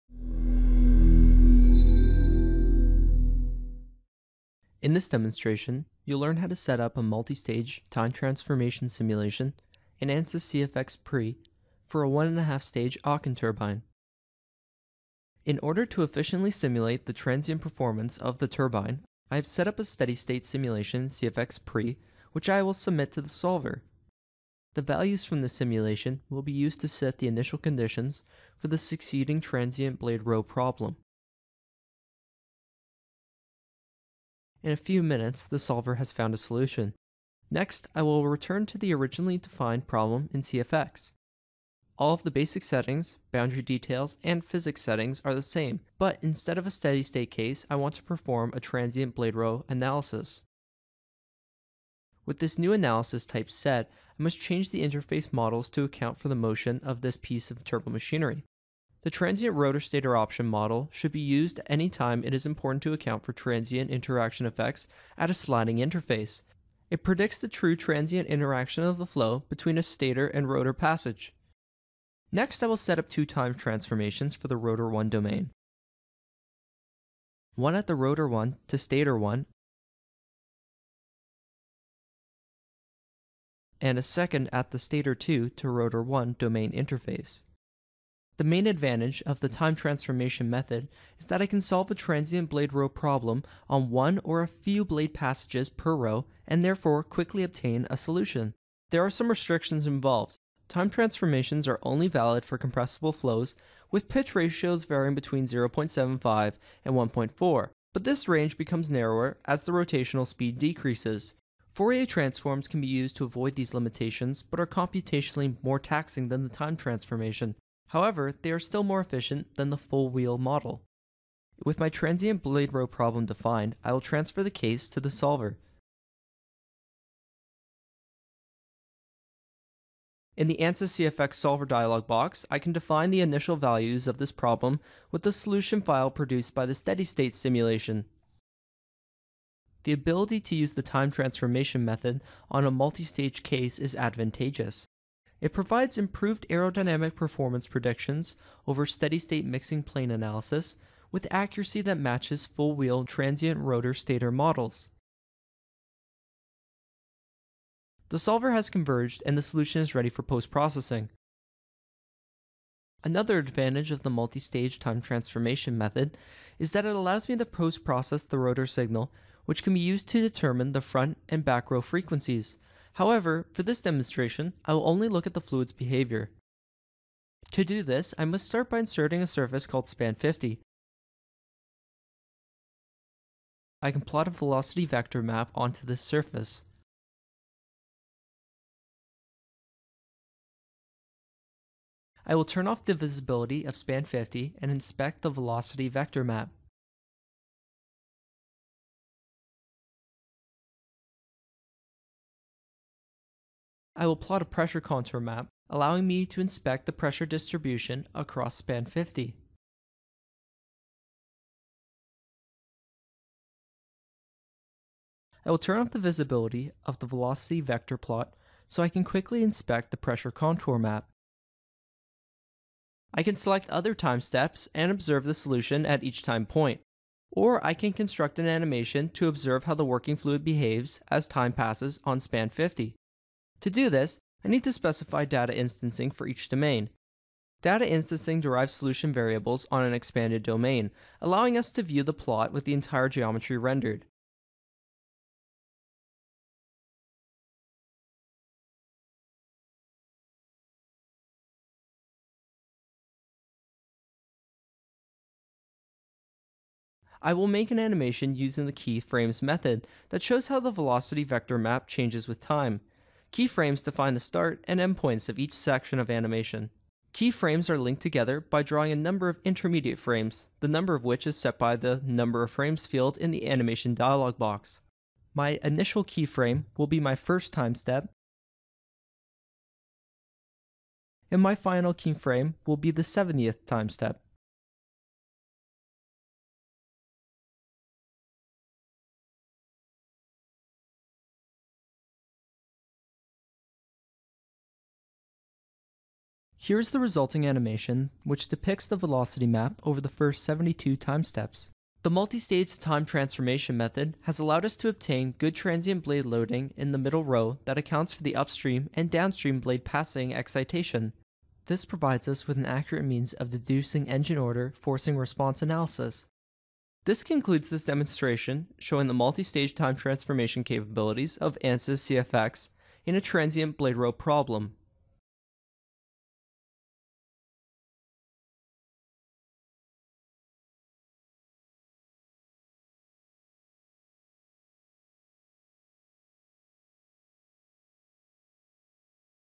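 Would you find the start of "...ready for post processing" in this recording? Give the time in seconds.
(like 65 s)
159 s.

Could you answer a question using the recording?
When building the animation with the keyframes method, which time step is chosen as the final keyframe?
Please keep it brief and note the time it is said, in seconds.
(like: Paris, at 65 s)
70th, at 283 s.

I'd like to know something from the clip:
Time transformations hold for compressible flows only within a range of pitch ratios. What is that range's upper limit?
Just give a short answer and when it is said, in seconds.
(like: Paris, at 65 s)
1.4, at 106 s.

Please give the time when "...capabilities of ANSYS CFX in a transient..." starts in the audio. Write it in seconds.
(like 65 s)
320 s.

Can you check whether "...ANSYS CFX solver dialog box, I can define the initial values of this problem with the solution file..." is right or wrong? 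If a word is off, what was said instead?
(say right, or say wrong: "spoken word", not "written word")
right.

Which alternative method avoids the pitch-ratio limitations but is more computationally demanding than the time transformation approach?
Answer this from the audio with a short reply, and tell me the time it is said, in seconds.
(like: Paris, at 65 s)
Fourier transforms, at 111 s.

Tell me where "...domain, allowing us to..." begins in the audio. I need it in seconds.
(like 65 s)
240 s.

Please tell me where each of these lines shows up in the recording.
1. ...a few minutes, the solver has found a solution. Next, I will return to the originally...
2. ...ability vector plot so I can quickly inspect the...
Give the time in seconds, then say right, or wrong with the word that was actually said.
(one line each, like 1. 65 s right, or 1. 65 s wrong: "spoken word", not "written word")
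1. 34 s right
2. 217 s wrong: "velocity", not "ability".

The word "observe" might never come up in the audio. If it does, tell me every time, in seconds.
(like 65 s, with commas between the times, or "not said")
224 s, 229 s.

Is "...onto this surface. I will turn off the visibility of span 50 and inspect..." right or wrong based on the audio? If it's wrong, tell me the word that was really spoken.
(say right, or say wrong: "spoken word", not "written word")
right.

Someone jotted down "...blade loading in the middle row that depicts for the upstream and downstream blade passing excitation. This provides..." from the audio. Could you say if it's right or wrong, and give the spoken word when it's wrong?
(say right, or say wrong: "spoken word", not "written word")
wrong: "accounts", not "depicts".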